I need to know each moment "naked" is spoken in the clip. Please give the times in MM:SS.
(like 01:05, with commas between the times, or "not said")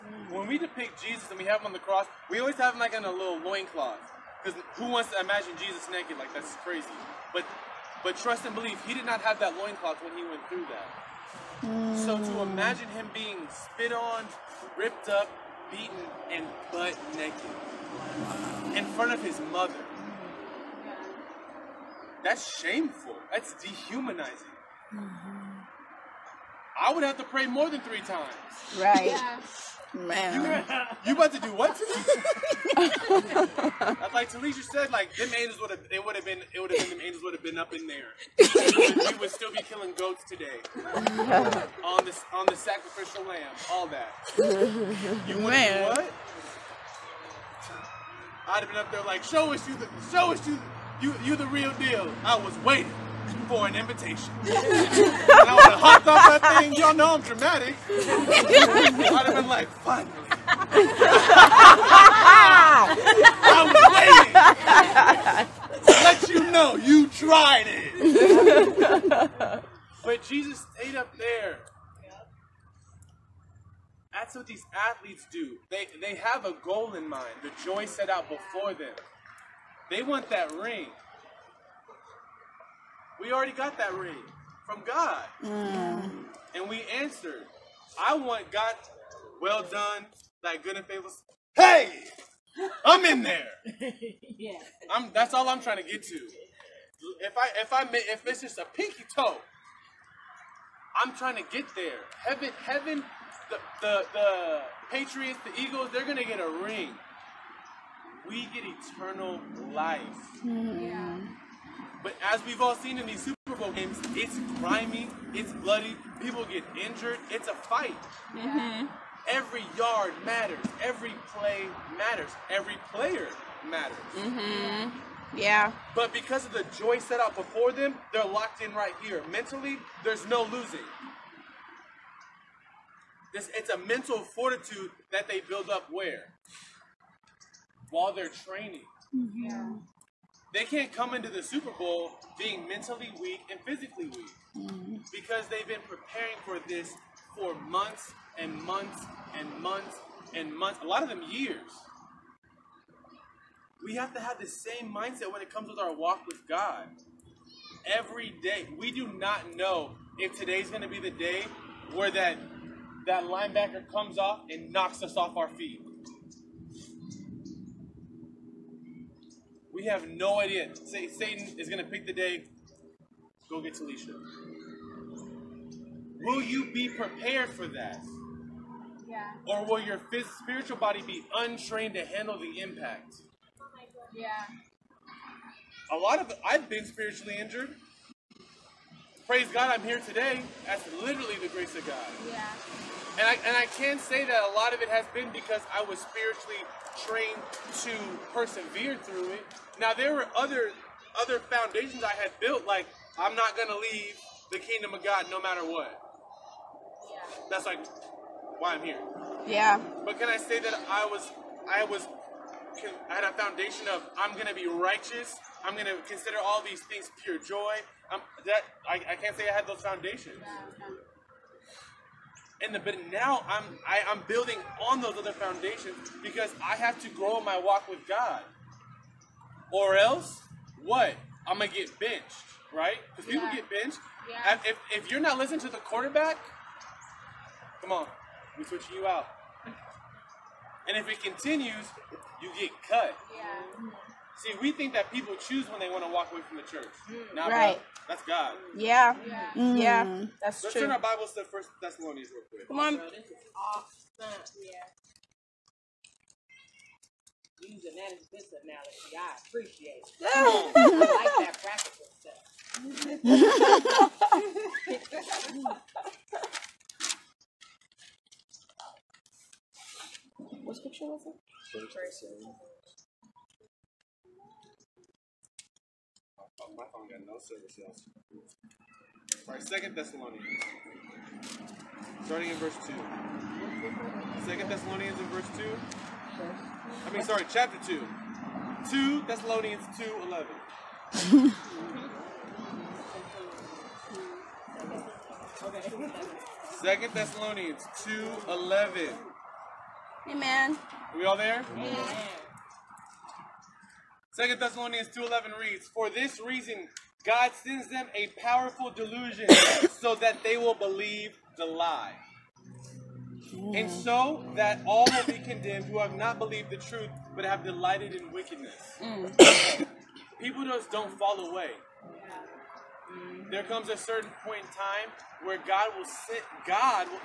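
00:05, 00:17.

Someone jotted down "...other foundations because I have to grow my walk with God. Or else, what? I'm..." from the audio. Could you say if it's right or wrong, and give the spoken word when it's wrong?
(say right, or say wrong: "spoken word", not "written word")
right.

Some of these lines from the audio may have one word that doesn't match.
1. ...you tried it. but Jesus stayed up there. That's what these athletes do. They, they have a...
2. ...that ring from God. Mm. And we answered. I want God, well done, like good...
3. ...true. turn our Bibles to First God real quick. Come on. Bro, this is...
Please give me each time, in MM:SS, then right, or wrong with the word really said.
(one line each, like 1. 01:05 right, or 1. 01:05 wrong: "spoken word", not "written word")
1. 01:06 right
2. 01:23 right
3. 04:10 wrong: "Thessalonians", not "God".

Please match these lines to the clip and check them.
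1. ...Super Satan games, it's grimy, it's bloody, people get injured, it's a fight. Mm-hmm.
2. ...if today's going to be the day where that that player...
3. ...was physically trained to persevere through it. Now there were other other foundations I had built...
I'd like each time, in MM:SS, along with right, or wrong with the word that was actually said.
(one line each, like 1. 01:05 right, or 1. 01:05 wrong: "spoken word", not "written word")
1. 01:53 wrong: "Bowl", not "Satan"
2. 02:40 wrong: "linebacker", not "player"
3. 03:15 wrong: "spiritually", not "physically".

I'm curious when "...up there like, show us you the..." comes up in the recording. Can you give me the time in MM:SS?
00:48.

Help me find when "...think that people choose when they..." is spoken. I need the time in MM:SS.
04:04.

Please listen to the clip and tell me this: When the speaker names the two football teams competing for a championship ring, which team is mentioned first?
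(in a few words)
Patriots.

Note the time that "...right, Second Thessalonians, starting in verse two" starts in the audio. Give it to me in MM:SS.
04:39.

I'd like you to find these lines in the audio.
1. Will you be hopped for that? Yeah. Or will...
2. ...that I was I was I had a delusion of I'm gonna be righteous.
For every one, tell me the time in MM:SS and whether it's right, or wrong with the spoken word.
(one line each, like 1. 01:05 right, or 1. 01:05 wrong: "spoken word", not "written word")
1. 02:56 wrong: "prepared", not "hopped"
2. 03:30 wrong: "foundation", not "delusion".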